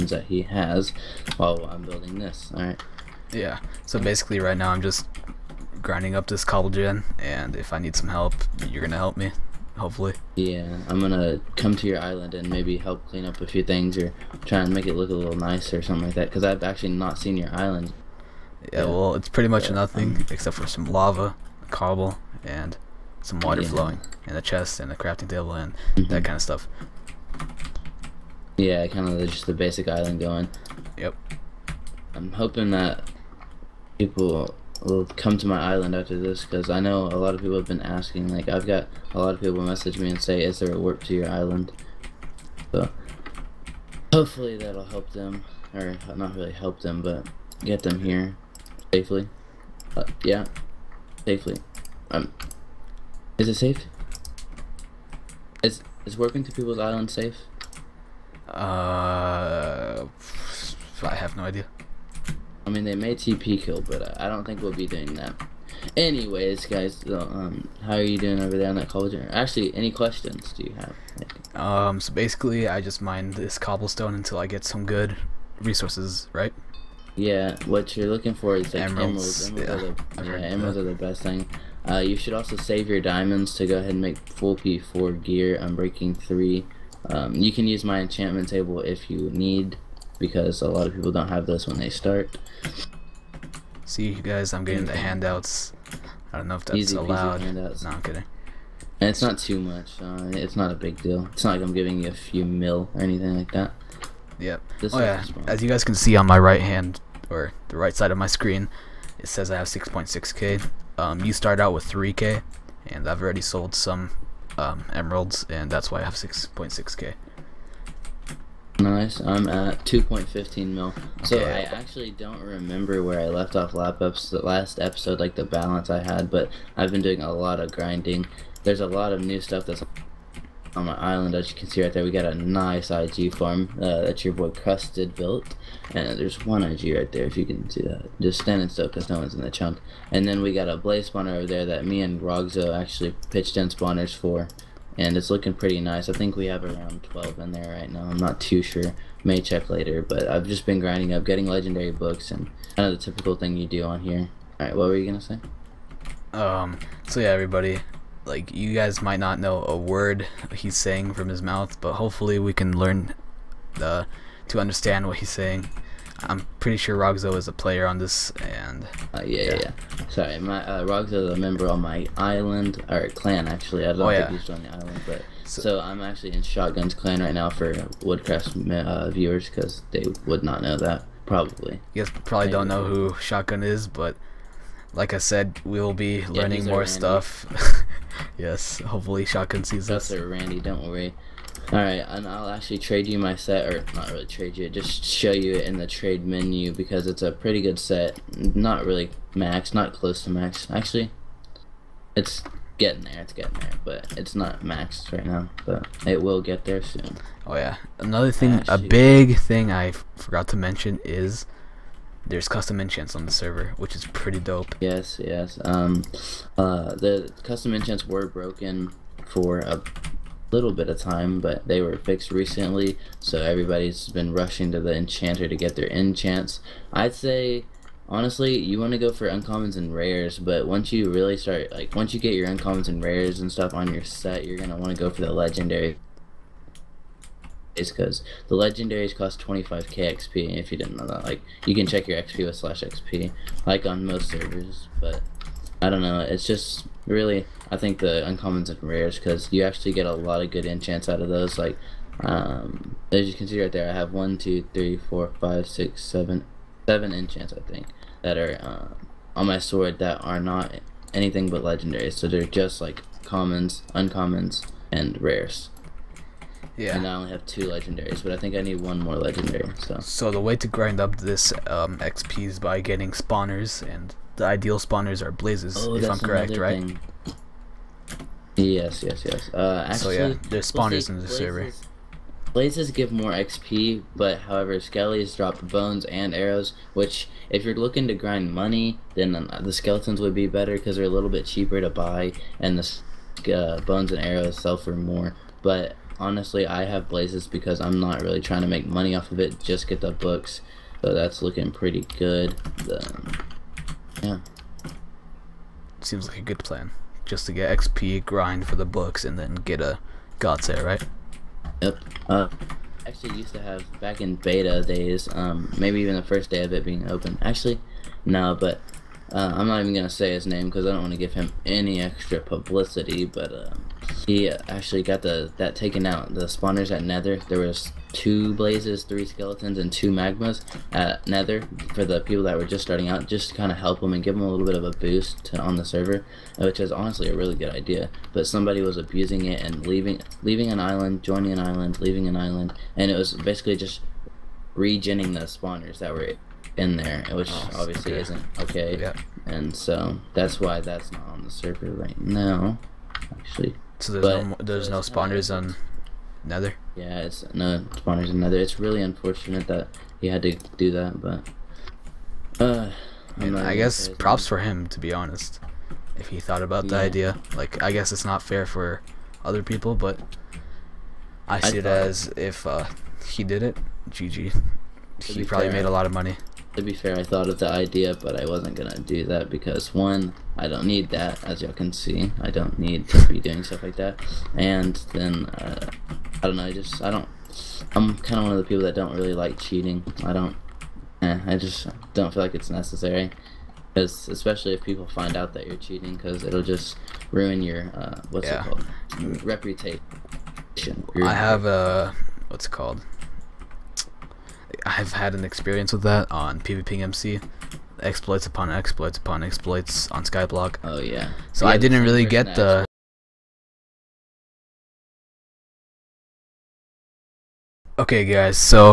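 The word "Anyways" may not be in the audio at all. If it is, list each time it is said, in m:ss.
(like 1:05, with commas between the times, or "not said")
1:05.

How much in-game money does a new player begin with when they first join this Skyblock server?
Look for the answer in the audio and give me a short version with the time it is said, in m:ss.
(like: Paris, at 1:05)
3k, at 1:51.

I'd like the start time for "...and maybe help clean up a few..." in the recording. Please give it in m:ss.
0:12.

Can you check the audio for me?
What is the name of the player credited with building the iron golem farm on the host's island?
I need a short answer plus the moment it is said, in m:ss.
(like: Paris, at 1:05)
Crusted, at 2:14.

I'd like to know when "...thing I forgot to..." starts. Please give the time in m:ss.
3:29.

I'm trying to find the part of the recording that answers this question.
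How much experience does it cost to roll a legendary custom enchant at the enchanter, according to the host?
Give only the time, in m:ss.
3:59.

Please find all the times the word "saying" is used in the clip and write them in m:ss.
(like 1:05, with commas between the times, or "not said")
2:40, 2:45.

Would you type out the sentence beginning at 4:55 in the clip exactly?
But honestly, I have blazes because I'm not really trying to make money off of it, just get the books.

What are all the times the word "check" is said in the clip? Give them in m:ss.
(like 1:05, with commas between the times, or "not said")
2:29, 4:01.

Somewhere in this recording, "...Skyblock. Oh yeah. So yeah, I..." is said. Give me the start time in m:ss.
6:50.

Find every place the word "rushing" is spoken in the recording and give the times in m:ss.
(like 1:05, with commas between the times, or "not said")
3:44.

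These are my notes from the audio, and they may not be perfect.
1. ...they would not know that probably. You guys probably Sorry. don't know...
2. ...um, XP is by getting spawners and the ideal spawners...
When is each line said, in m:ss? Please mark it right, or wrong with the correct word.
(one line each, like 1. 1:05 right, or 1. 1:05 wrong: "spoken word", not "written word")
1. 2:59 wrong: "Maybe", not "Sorry"
2. 4:31 right.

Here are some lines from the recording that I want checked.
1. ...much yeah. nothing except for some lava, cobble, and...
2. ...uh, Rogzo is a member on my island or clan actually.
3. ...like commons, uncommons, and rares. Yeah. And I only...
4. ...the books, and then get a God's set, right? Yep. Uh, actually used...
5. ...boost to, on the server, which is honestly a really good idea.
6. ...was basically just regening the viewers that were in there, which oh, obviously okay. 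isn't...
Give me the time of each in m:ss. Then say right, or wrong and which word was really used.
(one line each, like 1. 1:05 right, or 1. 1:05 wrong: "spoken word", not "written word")
1. 0:19 right
2. 2:50 right
3. 4:22 right
4. 5:08 right
5. 5:34 right
6. 5:43 wrong: "spawners", not "viewers".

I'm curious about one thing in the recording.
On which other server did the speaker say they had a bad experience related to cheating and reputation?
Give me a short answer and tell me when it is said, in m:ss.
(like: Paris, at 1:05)
PvPMC, at 6:46.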